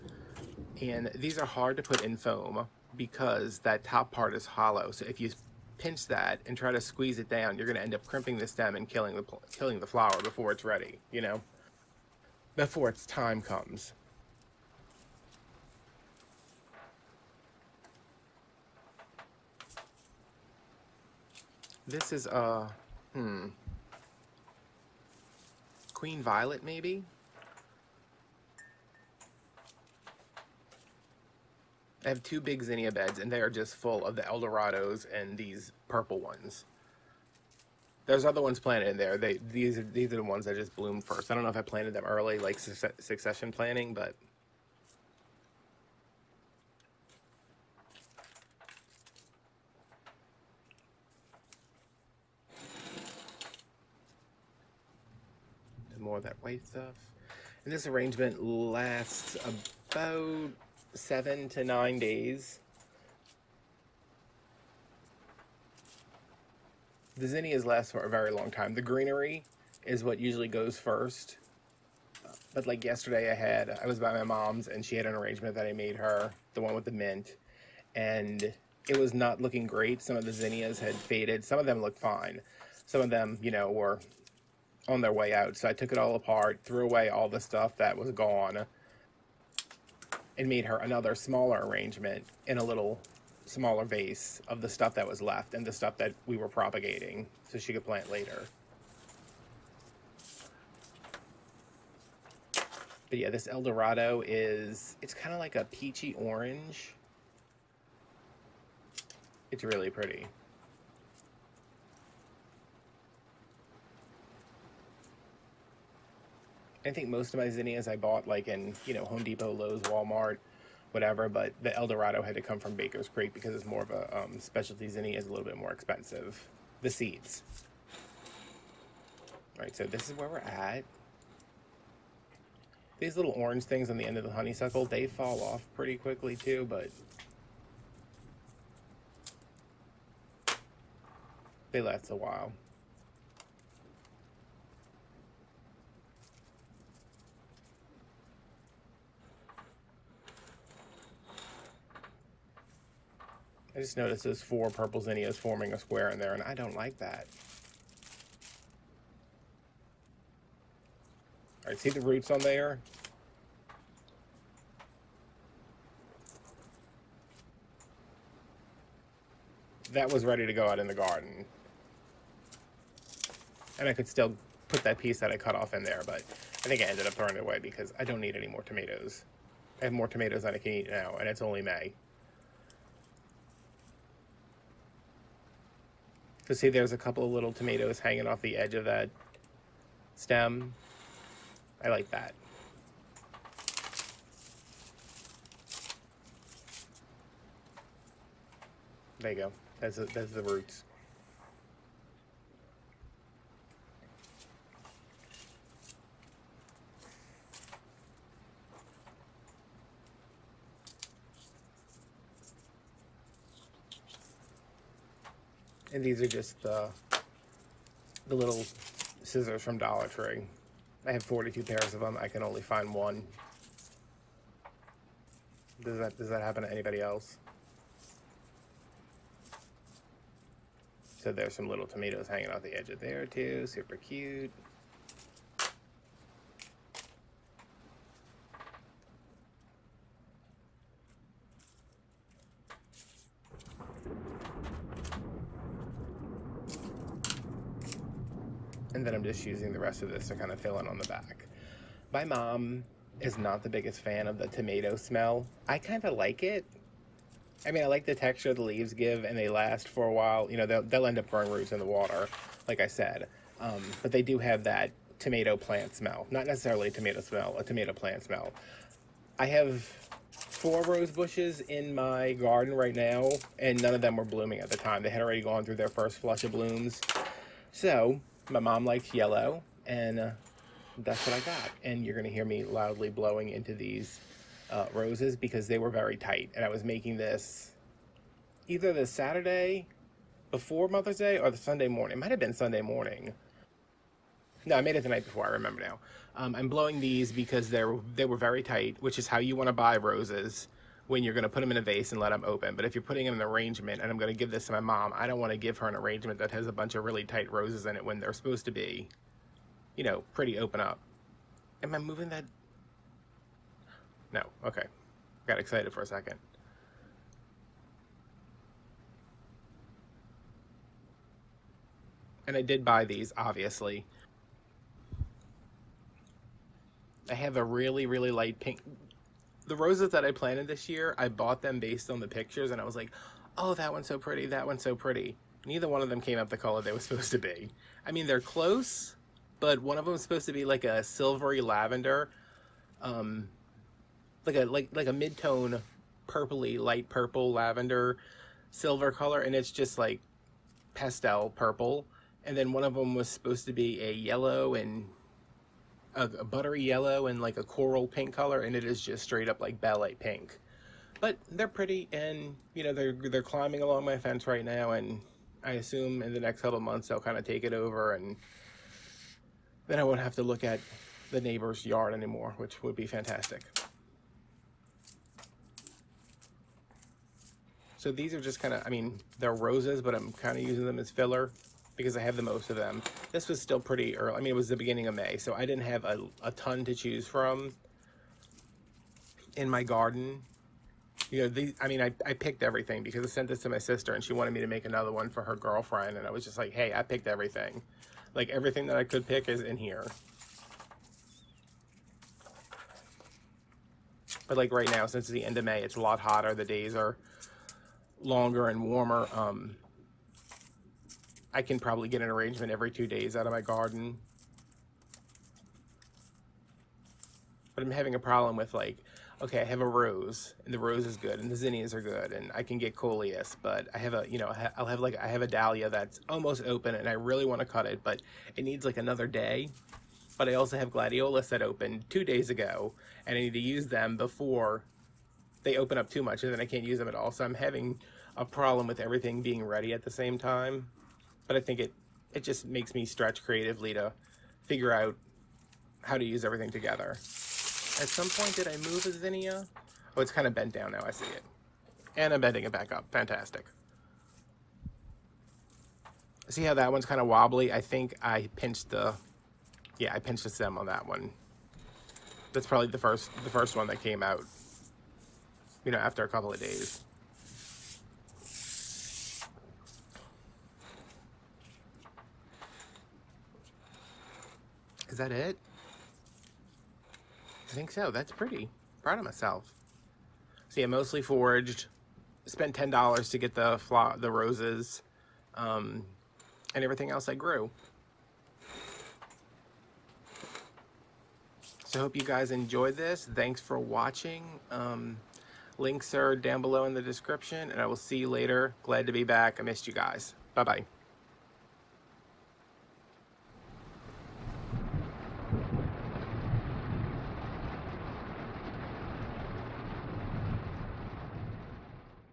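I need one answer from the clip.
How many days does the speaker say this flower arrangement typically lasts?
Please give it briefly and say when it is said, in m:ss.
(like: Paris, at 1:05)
7 to 9 days, at 1:00.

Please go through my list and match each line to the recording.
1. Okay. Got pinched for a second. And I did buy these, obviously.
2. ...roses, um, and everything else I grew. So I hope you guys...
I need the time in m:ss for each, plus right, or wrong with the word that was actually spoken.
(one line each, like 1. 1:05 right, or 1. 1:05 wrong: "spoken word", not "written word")
1. 5:14 wrong: "excited", not "pinched"
2. 8:04 right.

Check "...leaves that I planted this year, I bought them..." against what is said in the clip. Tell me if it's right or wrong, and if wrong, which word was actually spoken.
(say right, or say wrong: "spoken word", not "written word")
wrong: "roses", not "leaves".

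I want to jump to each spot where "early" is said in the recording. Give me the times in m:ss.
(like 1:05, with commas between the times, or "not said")
0:42, 6:24.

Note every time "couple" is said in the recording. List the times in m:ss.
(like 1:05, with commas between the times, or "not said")
3:06, 6:06, 7:46.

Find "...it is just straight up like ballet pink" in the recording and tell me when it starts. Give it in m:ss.
5:58.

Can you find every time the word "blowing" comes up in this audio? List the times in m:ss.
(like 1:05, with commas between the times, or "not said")
4:43, 4:56.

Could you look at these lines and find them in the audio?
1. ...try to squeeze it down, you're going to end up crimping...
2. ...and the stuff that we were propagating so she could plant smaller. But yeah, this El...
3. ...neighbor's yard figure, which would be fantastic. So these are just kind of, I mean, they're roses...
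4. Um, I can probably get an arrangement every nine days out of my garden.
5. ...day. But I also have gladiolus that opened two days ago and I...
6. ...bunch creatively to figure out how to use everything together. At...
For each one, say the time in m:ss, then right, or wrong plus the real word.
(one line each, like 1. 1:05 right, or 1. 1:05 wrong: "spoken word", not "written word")
1. 0:06 right
2. 1:35 wrong: "later", not "smaller"
3. 6:11 wrong: "anymore", not "figure"
4. 6:49 wrong: "two", not "nine"
5. 7:09 right
6. 7:23 wrong: "stretch", not "bunch".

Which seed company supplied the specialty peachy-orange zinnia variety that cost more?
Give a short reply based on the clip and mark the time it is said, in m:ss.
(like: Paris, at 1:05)
Baker's Creek, at 2:02.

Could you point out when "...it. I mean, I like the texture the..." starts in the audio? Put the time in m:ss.
4:16.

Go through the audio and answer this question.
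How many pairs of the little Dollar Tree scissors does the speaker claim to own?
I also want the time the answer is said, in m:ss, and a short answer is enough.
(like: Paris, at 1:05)
42, at 3:41.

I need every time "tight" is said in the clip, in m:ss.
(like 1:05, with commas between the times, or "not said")
4:46, 4:58, 5:07.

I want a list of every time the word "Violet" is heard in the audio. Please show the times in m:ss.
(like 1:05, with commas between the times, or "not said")
0:26.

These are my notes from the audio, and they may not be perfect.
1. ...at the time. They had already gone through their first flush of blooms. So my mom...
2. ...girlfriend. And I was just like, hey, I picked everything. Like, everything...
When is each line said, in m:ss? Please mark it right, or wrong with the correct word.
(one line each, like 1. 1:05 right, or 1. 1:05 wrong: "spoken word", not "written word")
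1. 4:34 right
2. 6:35 right.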